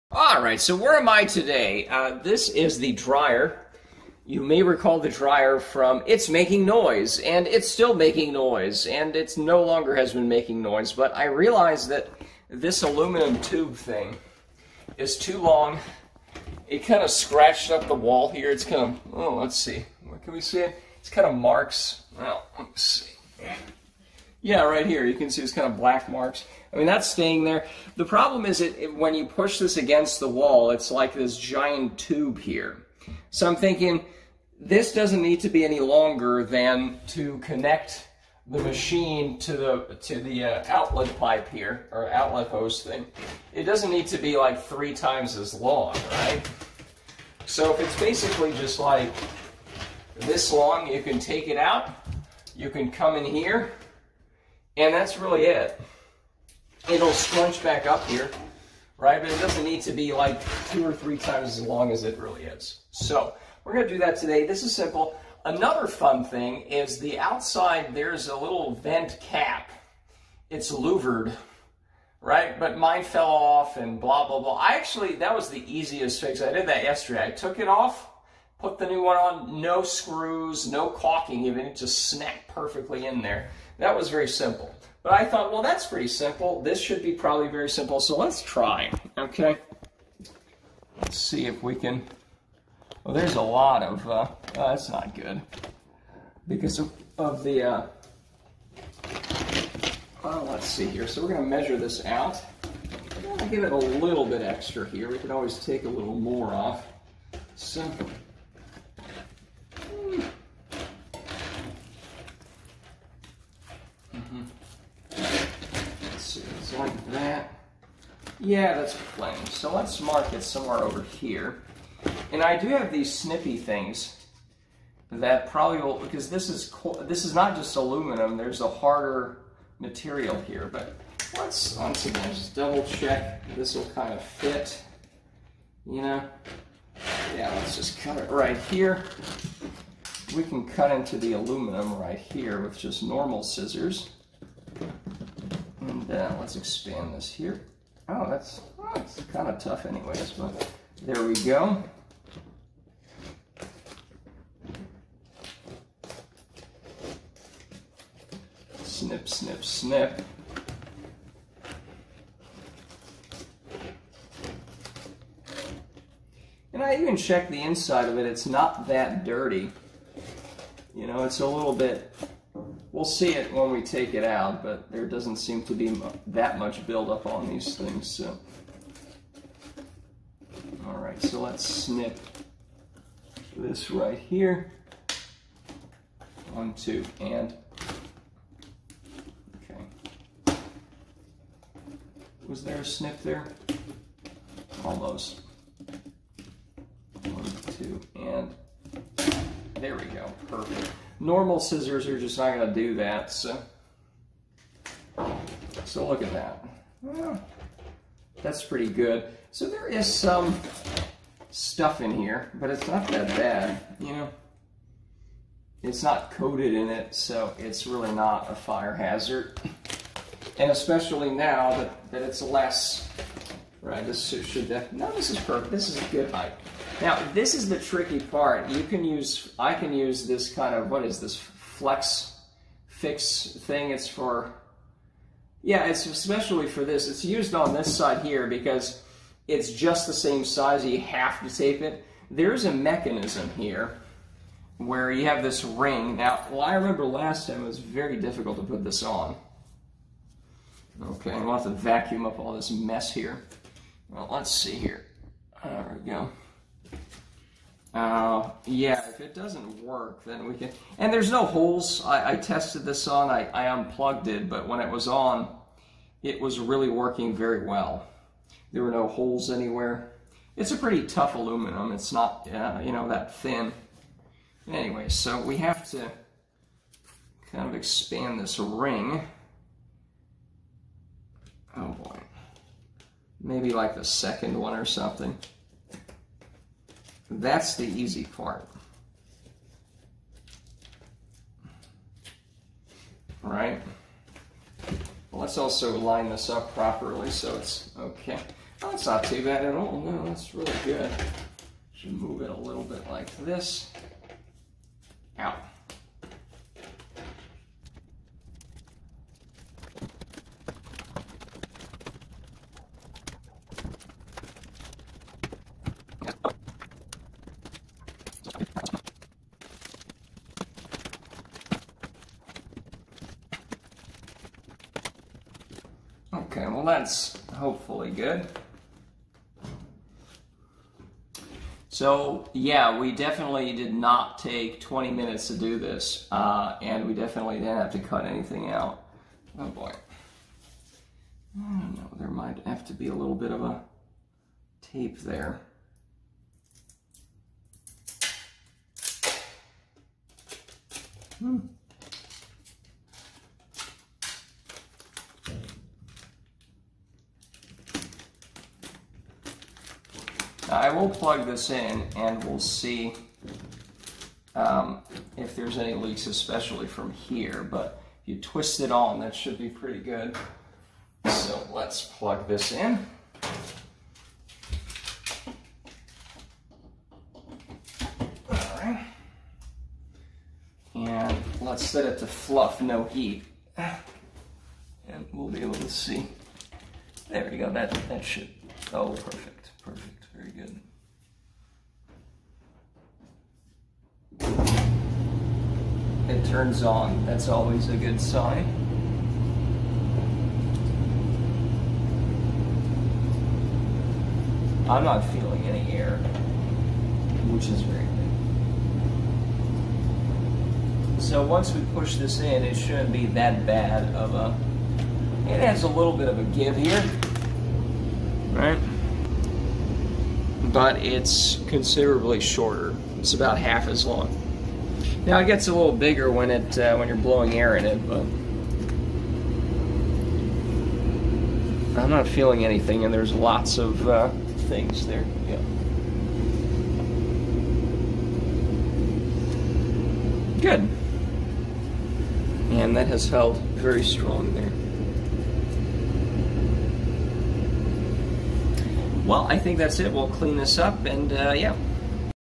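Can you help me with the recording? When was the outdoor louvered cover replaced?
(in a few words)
yesterday.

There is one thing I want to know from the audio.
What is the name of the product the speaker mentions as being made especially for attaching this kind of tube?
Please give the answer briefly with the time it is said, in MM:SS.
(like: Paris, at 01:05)
flex fix, at 03:51.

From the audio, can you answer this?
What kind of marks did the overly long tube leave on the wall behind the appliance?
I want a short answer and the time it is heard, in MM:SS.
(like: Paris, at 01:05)
black marks, at 00:25.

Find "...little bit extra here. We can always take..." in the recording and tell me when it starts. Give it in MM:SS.
01:43.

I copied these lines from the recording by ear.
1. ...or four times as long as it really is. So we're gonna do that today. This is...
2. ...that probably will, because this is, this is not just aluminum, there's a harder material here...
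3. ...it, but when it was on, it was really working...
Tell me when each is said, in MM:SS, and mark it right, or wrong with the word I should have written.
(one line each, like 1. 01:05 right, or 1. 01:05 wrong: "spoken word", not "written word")
1. 01:00 wrong: "three", not "four"
2. 02:05 right
3. 04:24 right.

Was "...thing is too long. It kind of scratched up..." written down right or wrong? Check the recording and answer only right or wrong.
right.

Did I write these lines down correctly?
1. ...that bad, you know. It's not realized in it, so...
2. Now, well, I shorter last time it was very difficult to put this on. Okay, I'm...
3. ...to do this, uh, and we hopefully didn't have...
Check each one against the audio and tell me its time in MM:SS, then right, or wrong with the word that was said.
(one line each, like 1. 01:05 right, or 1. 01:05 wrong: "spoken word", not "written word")
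1. 03:33 wrong: "coated", not "realized"
2. 04:06 wrong: "remember", not "shorter"
3. 05:35 wrong: "definitely", not "hopefully".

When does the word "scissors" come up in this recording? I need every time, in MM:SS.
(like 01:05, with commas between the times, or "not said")
02:23, 03:21.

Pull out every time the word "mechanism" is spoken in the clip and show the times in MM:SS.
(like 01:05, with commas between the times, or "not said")
04:02.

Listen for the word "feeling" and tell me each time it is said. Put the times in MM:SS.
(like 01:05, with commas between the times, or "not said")
06:45, 07:12.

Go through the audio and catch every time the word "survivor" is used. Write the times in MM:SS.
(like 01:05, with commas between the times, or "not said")
not said.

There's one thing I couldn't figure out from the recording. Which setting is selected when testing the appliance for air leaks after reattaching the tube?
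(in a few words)
fluff, no heat.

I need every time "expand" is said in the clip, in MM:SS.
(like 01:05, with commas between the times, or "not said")
02:26, 04:37.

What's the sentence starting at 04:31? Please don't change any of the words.
It's not, uh, you know, that thin.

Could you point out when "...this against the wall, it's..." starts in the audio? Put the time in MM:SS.
00:29.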